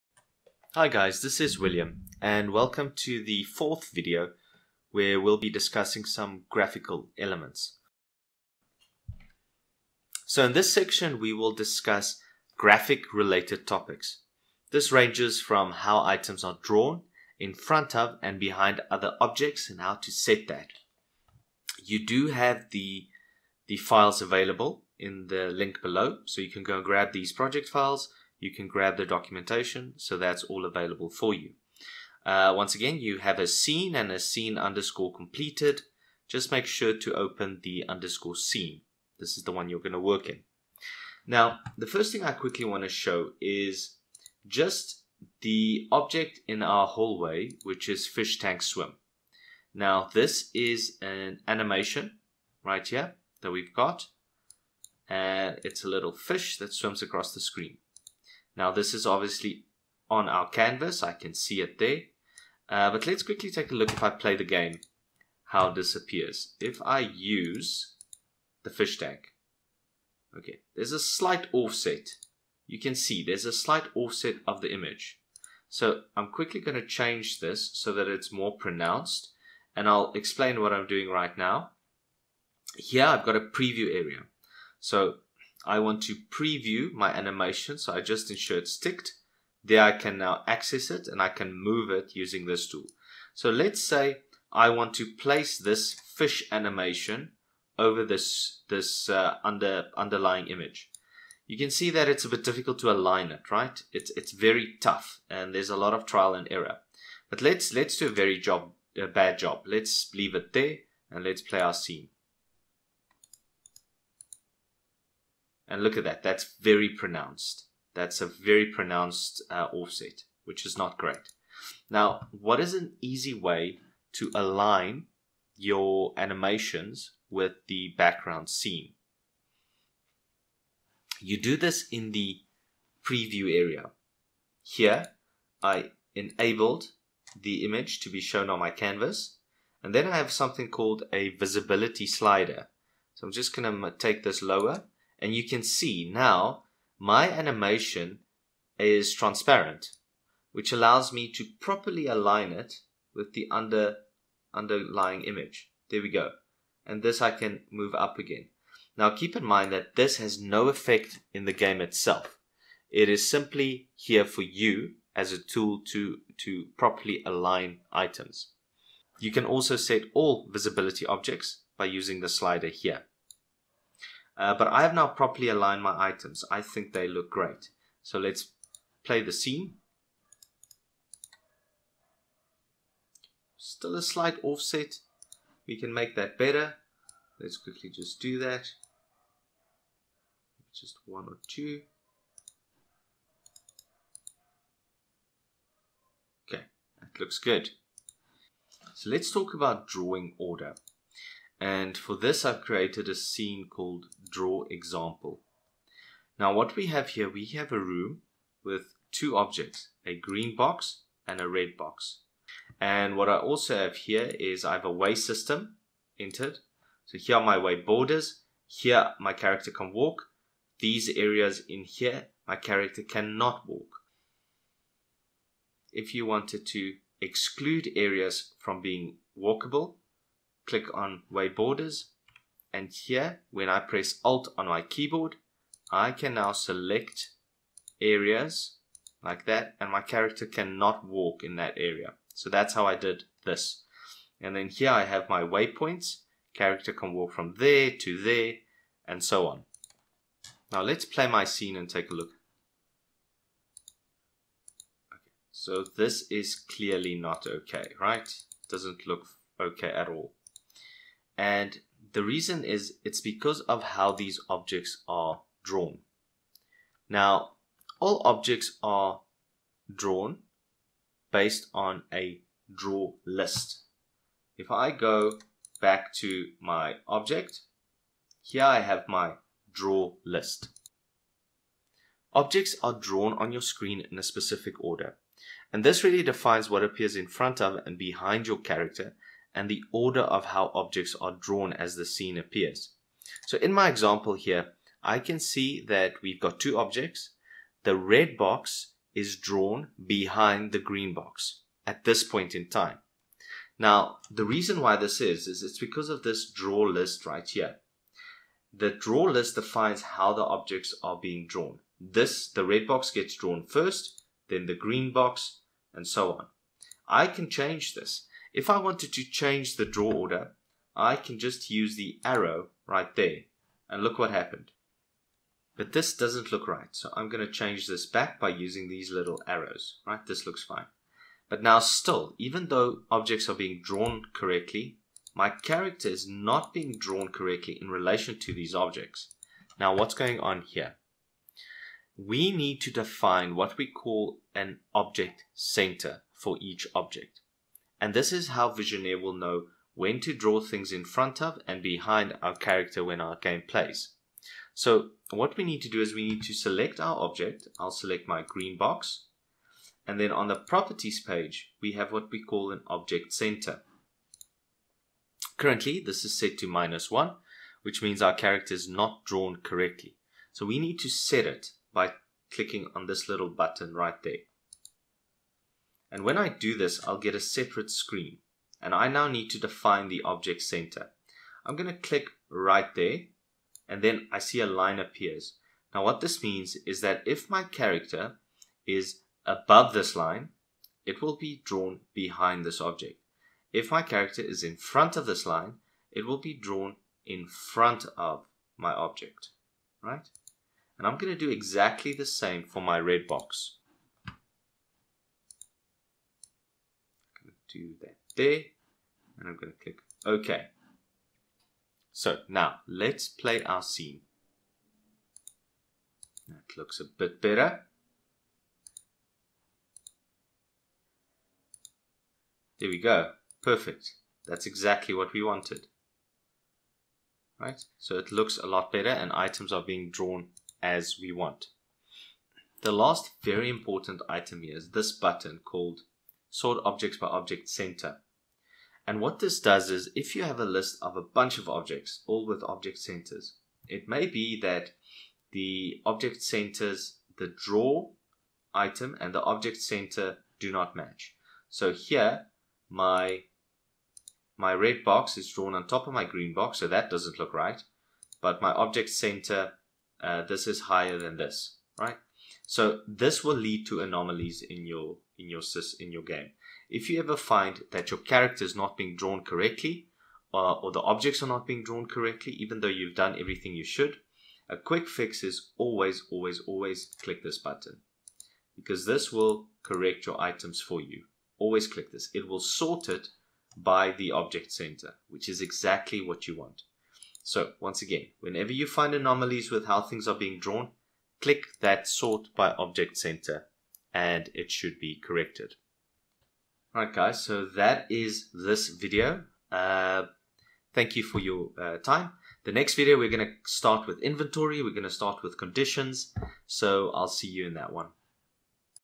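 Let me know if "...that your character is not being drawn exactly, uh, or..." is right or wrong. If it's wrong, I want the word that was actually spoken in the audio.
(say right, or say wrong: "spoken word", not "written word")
wrong: "correctly", not "exactly".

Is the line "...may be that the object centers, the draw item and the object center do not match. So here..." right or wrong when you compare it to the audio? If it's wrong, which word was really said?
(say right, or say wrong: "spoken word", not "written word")
right.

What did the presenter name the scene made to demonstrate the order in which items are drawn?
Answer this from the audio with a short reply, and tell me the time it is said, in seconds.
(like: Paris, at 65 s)
draw example, at 204 s.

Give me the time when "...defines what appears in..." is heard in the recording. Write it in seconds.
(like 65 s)
286 s.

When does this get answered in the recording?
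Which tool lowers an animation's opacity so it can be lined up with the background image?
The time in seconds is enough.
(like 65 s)
141 s.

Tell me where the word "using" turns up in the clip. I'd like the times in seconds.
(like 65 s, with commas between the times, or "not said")
92 s, 171 s, 328 s.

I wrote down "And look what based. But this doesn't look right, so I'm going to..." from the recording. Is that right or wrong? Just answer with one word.
wrong.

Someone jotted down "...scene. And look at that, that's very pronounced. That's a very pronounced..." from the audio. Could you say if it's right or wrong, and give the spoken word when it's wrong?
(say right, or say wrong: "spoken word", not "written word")
right.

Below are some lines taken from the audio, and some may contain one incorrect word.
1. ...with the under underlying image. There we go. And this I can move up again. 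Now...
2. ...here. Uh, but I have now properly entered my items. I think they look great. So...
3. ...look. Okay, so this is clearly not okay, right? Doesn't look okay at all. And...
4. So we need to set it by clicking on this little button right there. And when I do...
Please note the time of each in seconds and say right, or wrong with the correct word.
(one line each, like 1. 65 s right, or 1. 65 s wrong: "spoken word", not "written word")
1. 153 s right
2. 172 s wrong: "aligned", not "entered"
3. 252 s right
4. 370 s right.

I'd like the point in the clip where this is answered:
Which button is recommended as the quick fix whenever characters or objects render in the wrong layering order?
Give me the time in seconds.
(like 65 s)
436 s.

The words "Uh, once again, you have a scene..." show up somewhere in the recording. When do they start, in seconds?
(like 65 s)
32 s.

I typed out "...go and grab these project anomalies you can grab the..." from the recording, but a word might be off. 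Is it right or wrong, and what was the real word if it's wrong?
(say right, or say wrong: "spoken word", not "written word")
wrong: "files", not "anomalies".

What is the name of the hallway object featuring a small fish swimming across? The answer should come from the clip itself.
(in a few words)
fish tank swim.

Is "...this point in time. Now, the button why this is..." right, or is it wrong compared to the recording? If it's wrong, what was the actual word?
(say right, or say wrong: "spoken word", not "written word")
wrong: "reason", not "button".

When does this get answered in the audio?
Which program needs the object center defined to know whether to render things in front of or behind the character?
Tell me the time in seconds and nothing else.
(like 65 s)
348 s.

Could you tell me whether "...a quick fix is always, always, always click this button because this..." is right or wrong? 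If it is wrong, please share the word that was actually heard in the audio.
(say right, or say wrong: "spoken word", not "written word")
right.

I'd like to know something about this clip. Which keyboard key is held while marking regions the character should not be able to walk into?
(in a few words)
Alt.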